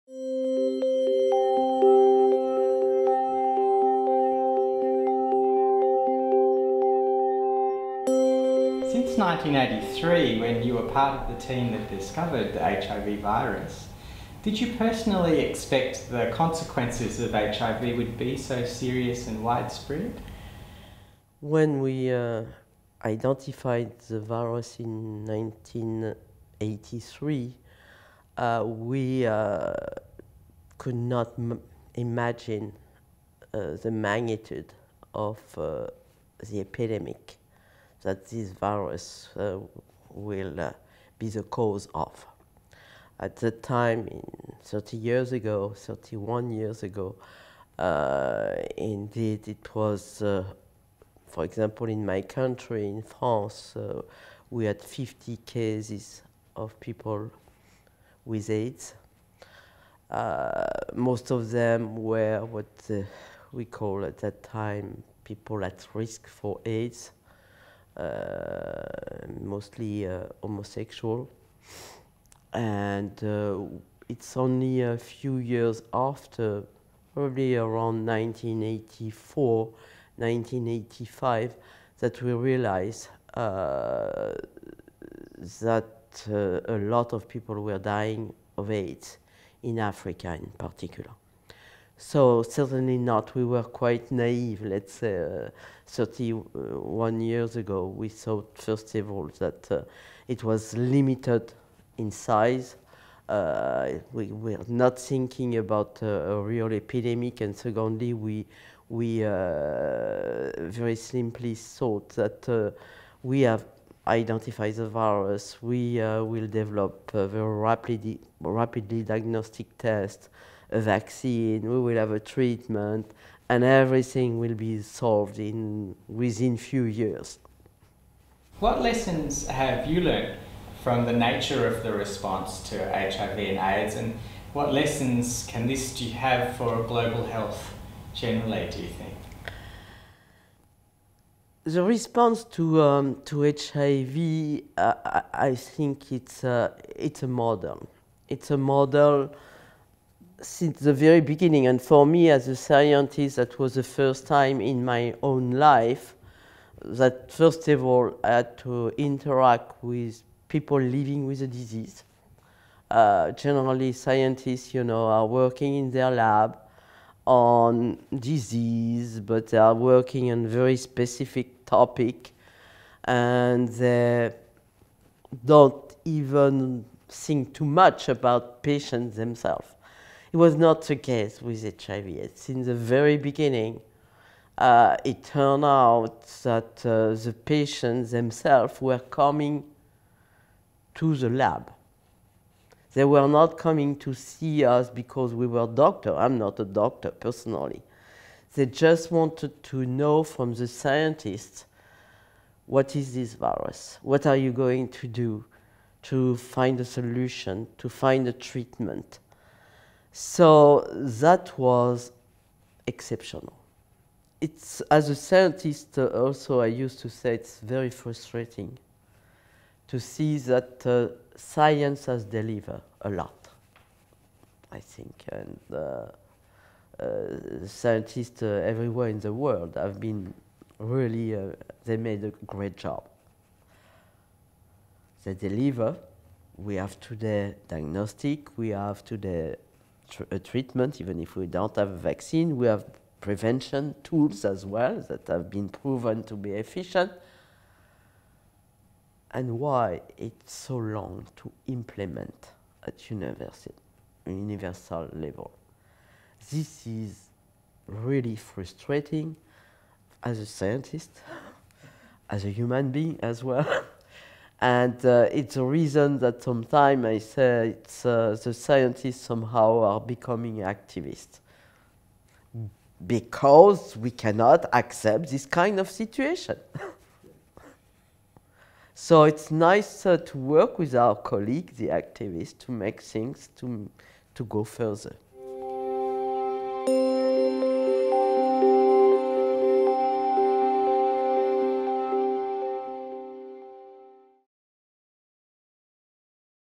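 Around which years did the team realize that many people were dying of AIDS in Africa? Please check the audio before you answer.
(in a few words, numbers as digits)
1984, 1985.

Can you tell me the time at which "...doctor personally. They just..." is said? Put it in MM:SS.
03:16.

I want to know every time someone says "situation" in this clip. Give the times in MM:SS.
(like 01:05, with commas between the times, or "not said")
04:35.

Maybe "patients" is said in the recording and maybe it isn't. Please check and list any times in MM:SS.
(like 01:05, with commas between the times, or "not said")
02:58, 03:07.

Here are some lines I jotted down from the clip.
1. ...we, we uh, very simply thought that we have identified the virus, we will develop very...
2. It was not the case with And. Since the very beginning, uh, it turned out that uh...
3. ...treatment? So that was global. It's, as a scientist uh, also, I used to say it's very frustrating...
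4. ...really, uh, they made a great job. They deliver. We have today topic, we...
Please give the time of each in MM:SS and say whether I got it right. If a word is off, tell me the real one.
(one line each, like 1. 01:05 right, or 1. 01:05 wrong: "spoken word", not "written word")
1. 01:48 right
2. 03:00 wrong: "HIV", not "And"
3. 03:28 wrong: "exceptional", not "global"
4. 03:50 wrong: "diagnostic", not "topic".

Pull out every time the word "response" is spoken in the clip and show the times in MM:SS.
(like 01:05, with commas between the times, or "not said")
02:11, 02:21.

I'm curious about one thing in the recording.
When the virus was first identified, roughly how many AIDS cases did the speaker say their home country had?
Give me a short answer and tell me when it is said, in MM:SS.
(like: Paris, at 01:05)
50, at 00:54.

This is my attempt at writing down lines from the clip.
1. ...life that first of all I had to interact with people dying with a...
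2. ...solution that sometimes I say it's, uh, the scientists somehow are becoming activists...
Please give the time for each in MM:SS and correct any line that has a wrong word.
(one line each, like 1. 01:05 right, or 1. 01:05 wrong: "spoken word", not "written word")
1. 02:35 wrong: "living", not "dying"
2. 04:25 wrong: "reason", not "solution".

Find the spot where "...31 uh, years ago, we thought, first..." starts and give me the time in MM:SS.
01:35.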